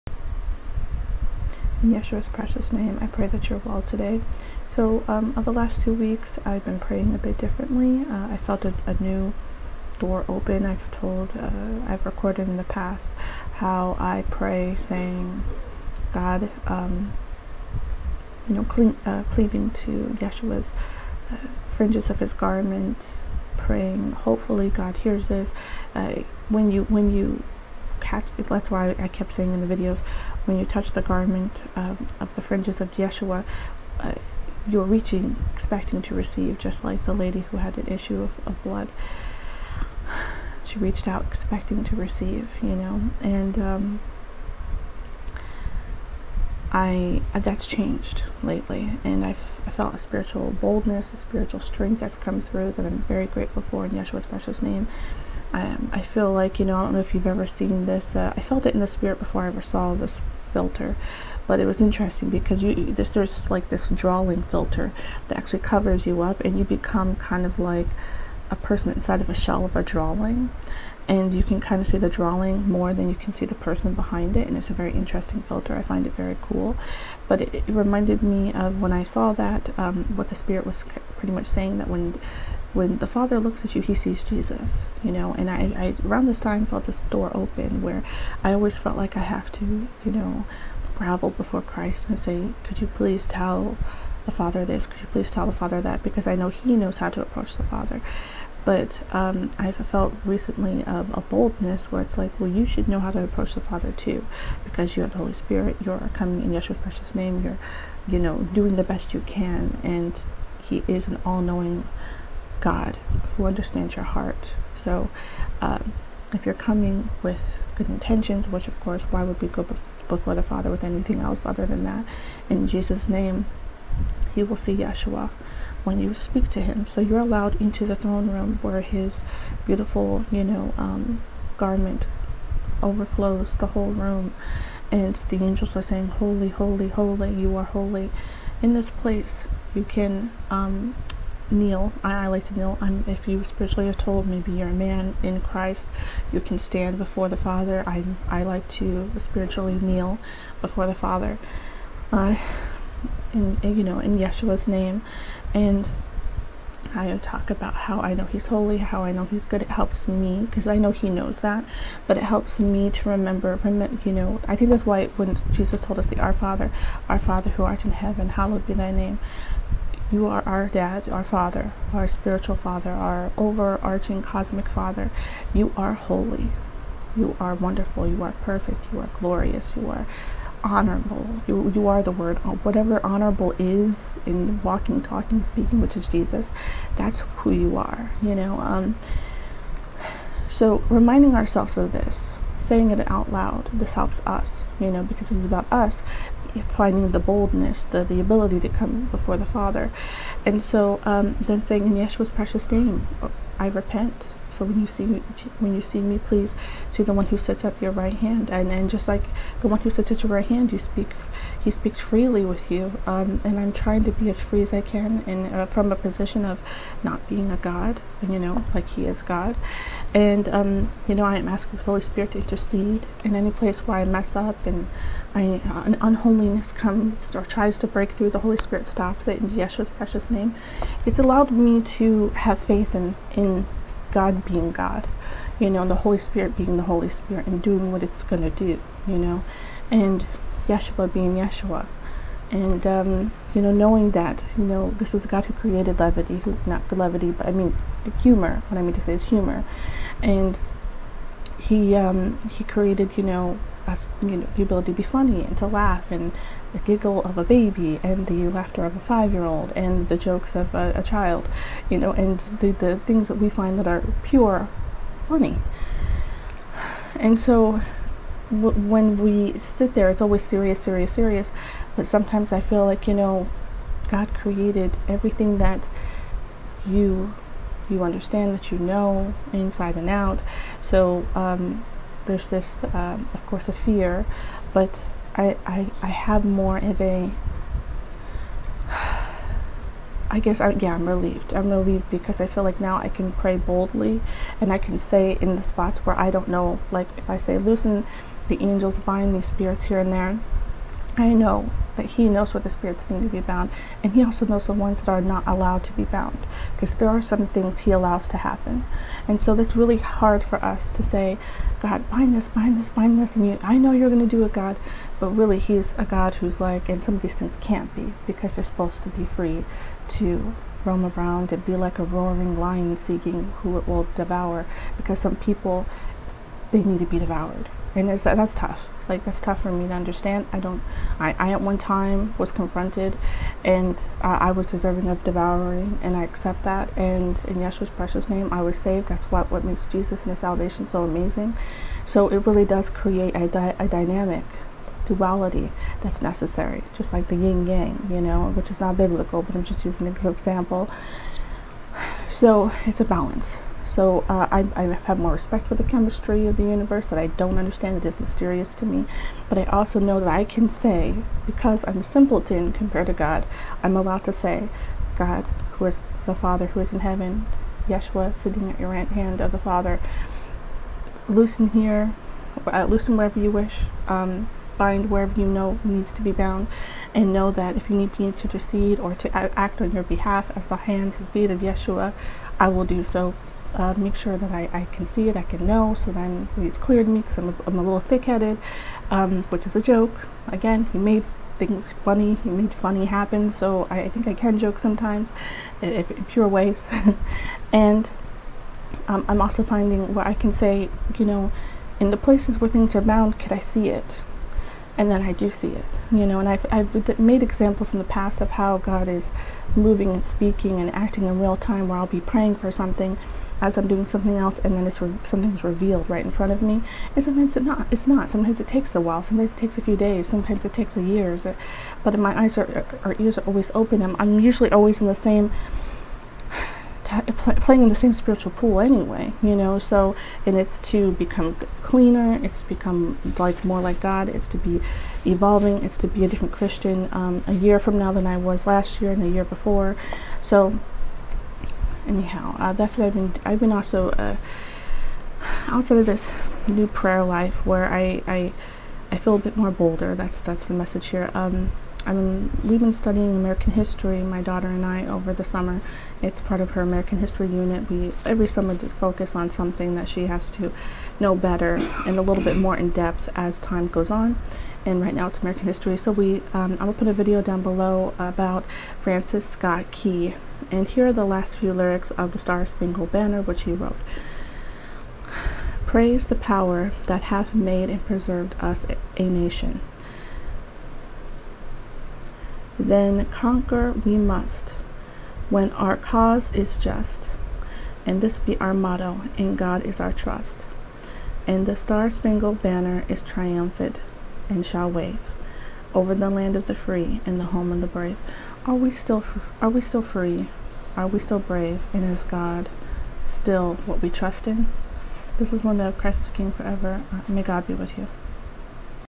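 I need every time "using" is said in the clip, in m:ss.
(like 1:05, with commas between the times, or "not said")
5:49.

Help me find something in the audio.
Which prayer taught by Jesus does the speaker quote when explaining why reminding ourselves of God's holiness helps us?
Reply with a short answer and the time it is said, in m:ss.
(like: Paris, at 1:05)
The Our Father, at 2:46.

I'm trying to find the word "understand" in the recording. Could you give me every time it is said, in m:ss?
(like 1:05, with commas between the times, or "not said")
1:53, 4:38, 5:29, 5:57.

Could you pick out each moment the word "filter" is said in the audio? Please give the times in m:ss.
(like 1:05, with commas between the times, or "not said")
1:00, 1:04, 1:15.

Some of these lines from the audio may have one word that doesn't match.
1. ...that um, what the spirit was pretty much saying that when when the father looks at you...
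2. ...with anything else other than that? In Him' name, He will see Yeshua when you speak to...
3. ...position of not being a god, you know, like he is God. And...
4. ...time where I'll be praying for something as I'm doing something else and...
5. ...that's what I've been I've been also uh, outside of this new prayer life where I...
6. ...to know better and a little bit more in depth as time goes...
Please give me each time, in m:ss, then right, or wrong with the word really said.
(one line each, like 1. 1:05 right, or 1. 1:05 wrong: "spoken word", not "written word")
1. 1:19 right
2. 2:00 wrong: "Jesus", not "Him"
3. 3:35 right
4. 6:51 right
5. 7:22 right
6. 7:40 right.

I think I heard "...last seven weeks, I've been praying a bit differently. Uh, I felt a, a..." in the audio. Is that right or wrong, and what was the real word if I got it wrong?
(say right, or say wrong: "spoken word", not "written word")
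wrong: "two", not "seven".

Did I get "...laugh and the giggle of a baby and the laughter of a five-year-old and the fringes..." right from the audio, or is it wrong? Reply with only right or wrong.
wrong.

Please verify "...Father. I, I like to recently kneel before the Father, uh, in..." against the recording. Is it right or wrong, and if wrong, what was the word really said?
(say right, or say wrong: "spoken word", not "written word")
wrong: "spiritually", not "recently".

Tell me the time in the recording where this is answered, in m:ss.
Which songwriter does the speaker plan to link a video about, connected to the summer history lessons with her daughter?
7:48.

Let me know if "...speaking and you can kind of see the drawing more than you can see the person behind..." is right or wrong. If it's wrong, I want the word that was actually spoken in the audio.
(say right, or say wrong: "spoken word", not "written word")
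wrong: "drawing", not "speaking".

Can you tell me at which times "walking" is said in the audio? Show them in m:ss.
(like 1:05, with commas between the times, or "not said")
3:04.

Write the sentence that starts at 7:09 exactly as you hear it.
So, and it's to become cleaner.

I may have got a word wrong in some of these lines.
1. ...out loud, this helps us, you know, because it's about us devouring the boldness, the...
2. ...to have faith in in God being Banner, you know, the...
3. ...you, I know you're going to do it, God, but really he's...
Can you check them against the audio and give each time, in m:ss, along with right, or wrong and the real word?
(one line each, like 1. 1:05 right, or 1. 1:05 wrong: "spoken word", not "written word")
1. 3:13 wrong: "finding", not "devouring"
2. 3:51 wrong: "God", not "Banner"
3. 5:13 right.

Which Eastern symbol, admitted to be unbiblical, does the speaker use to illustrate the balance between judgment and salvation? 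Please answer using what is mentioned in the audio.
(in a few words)
Yin yang.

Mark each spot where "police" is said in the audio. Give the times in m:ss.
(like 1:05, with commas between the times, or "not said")
not said.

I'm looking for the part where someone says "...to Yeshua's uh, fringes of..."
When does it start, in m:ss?
0:19.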